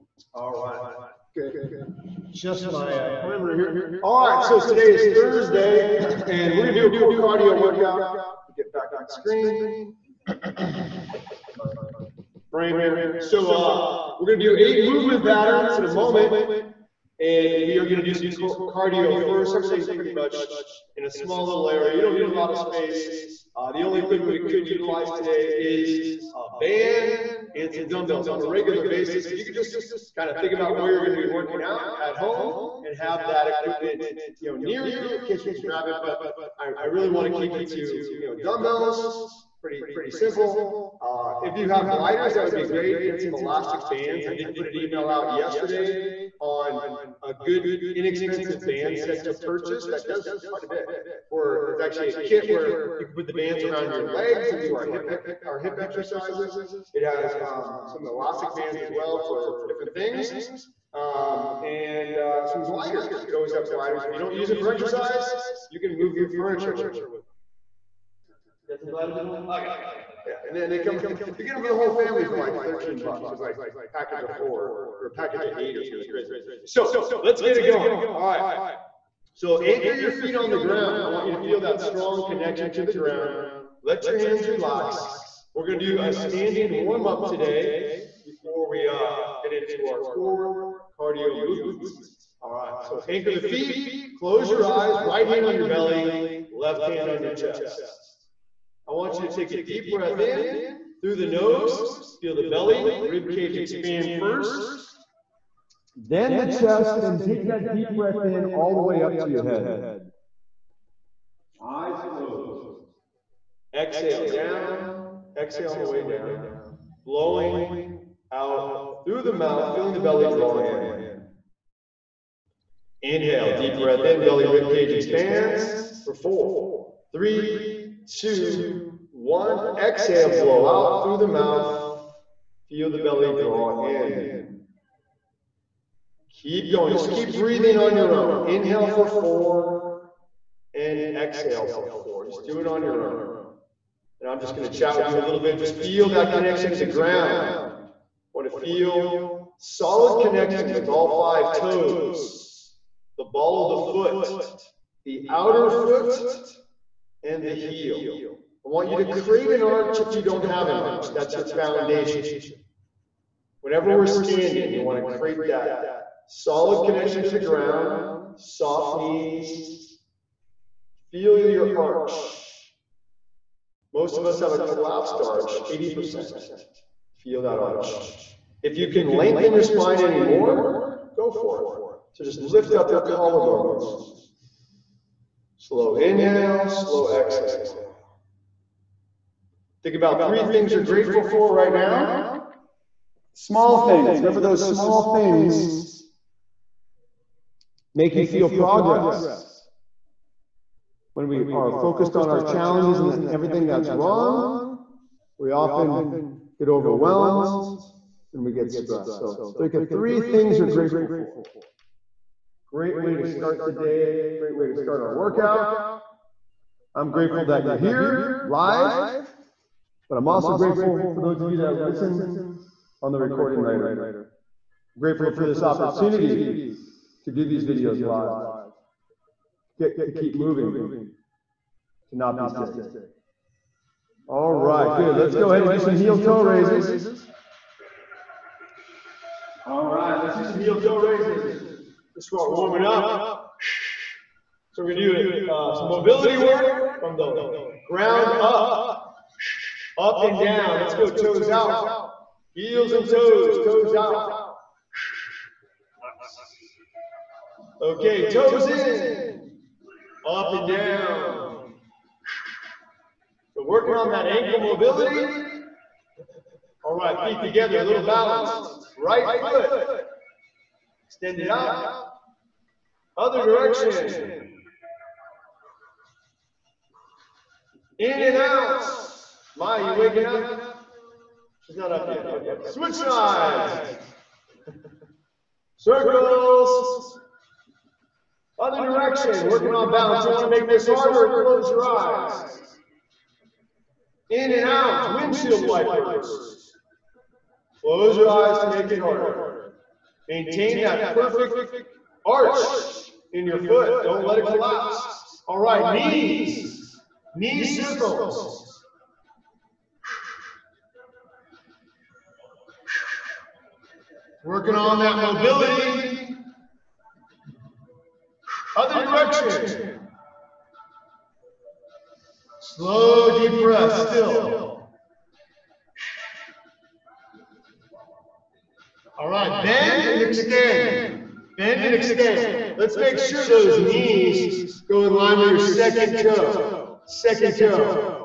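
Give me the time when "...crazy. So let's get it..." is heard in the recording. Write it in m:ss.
1:16.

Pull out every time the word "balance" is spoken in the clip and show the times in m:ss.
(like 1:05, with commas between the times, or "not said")
4:28, 4:49.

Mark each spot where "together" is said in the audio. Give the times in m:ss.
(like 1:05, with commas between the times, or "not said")
4:27.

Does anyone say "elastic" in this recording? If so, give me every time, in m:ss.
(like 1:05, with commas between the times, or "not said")
0:43, 0:58.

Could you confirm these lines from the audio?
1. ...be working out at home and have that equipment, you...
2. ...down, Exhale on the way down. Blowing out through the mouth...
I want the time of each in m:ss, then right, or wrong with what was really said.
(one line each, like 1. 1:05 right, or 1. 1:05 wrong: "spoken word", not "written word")
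1. 0:31 right
2. 1:54 right.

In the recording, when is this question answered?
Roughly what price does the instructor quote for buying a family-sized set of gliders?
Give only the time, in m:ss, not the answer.
1:12.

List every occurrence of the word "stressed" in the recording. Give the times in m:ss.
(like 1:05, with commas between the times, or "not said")
3:28.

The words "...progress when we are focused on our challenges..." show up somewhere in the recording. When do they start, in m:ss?
3:18.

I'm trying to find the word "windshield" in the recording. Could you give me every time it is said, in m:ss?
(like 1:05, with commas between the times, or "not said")
4:55.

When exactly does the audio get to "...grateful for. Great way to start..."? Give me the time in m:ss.
3:30.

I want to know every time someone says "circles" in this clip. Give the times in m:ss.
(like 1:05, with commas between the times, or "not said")
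4:45, 5:07.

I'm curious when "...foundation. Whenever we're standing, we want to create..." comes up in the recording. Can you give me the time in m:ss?
2:41.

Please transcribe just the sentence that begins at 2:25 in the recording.
Just feel that connection to the ground.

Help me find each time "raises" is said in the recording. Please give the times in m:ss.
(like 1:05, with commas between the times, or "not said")
3:56, 4:00.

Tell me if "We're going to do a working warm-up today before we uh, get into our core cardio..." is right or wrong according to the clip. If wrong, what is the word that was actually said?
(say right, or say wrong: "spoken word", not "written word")
wrong: "standing", not "working".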